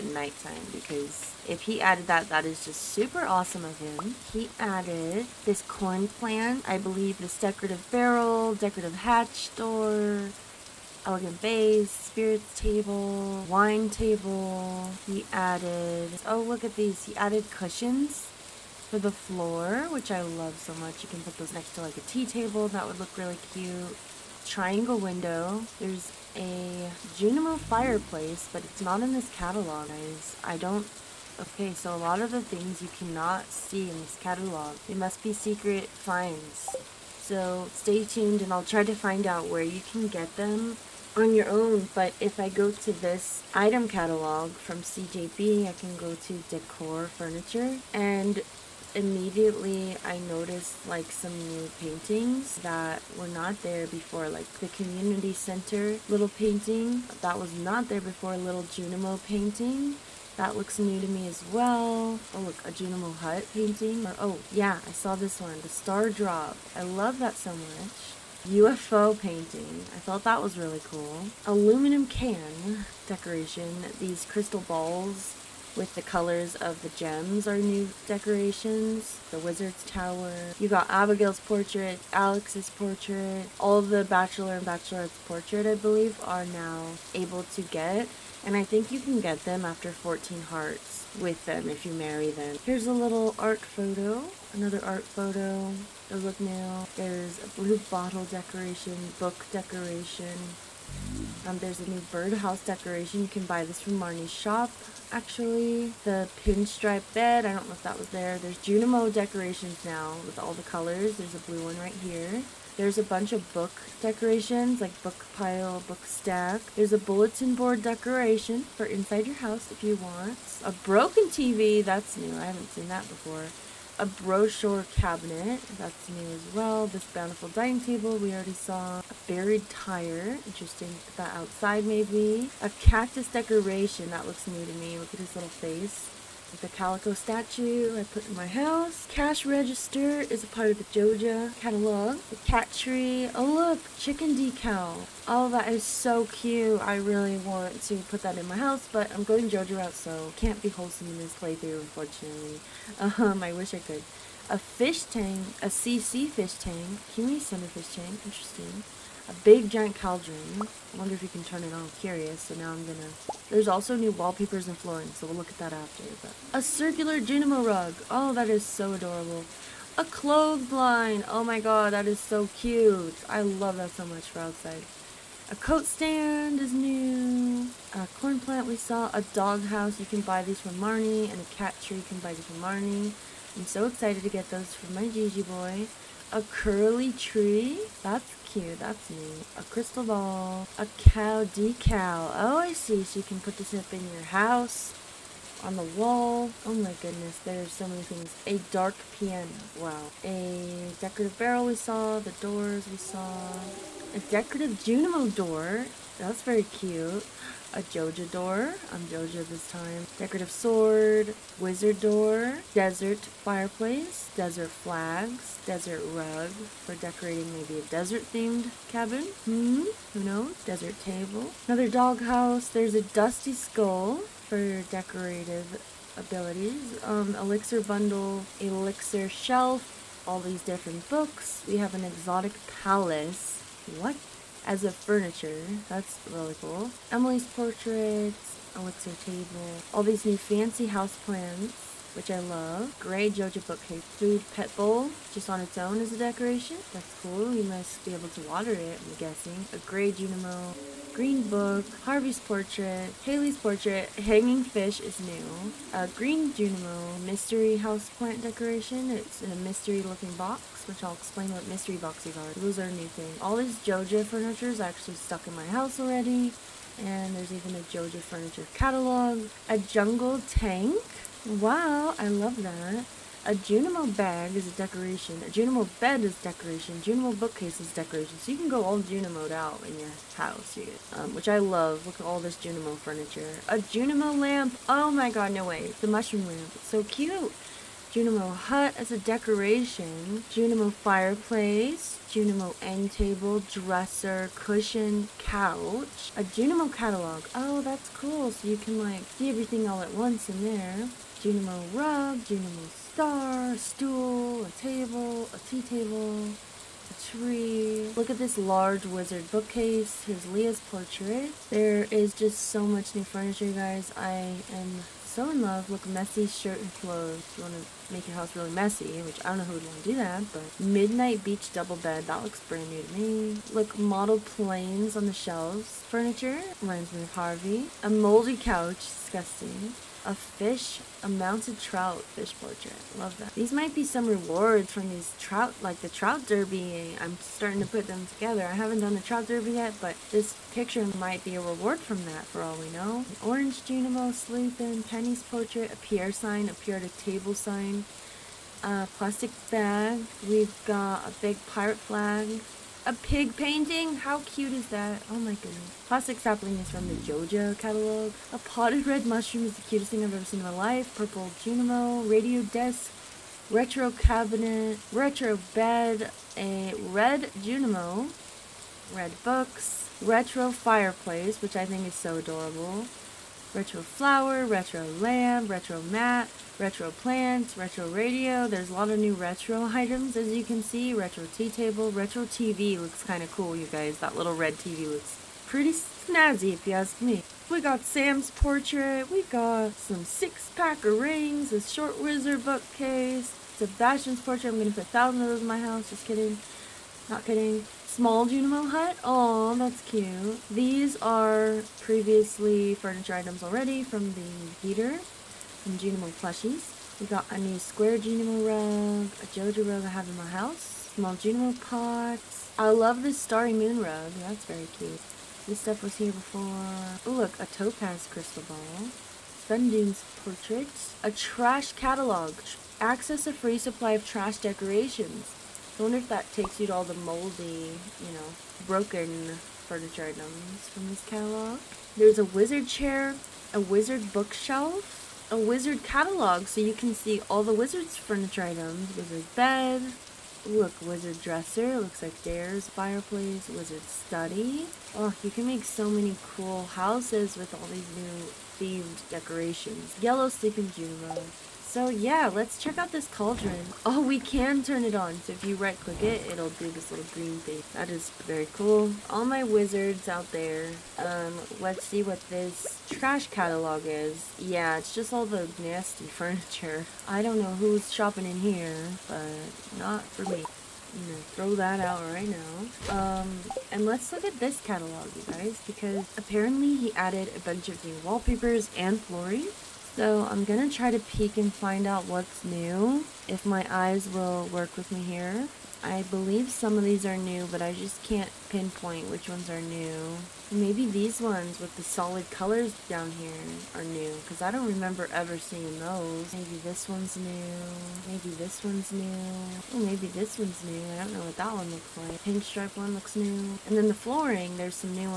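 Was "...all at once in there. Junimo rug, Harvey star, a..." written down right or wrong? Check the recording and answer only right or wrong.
wrong.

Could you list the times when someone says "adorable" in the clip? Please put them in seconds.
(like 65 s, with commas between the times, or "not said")
168 s, 372 s.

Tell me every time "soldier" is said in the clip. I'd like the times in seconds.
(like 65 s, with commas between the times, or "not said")
not said.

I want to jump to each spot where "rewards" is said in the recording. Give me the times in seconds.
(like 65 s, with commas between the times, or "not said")
334 s, 341 s.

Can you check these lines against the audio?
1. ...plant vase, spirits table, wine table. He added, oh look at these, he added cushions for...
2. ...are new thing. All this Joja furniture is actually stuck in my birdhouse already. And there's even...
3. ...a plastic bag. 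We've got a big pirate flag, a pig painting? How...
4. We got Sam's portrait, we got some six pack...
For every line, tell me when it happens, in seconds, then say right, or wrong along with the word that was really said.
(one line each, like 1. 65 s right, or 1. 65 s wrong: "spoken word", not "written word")
1. 11 s wrong: "elegant", not "plant"
2. 262 s wrong: "house", not "birdhouse"
3. 348 s right
4. 387 s right.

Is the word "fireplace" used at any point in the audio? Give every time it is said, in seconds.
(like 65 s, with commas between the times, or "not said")
27 s, 213 s, 290 s, 370 s, 442 s.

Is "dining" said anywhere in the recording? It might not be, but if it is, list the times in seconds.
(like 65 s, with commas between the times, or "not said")
127 s.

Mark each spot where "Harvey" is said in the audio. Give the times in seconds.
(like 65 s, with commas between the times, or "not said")
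252 s, 327 s.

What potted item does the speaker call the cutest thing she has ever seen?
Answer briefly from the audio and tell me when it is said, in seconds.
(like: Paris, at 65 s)
Potted red mushroom, at 358 s.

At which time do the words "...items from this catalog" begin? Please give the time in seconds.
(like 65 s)
430 s.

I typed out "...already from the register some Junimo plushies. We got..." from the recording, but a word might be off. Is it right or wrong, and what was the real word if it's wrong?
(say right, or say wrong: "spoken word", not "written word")
wrong: "heater", not "register".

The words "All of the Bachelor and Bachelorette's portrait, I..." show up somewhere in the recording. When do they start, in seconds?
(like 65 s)
83 s.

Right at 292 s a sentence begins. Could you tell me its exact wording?
Junimo end table, dresser, cushion, couch.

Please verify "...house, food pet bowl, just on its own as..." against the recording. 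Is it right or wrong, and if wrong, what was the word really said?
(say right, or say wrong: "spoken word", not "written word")
wrong: "bookcase", not "house".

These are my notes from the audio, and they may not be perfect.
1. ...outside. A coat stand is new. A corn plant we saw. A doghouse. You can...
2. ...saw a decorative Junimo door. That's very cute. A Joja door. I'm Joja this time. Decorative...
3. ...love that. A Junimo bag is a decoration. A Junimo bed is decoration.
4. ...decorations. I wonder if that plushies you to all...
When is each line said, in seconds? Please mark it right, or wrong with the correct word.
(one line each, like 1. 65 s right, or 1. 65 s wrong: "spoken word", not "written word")
1. 174 s right
2. 202 s right
3. 272 s right
4. 424 s wrong: "takes", not "plushies".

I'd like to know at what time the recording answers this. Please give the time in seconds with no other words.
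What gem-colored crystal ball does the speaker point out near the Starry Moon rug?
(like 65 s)
417 s.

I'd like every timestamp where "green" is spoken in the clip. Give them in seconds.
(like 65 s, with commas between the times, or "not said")
251 s, 256 s, 457 s.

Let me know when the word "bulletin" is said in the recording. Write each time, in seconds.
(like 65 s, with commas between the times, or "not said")
116 s.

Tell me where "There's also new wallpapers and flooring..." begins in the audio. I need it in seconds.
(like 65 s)
163 s.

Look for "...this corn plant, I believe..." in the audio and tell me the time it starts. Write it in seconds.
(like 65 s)
5 s.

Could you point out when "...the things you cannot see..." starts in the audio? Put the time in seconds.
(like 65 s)
32 s.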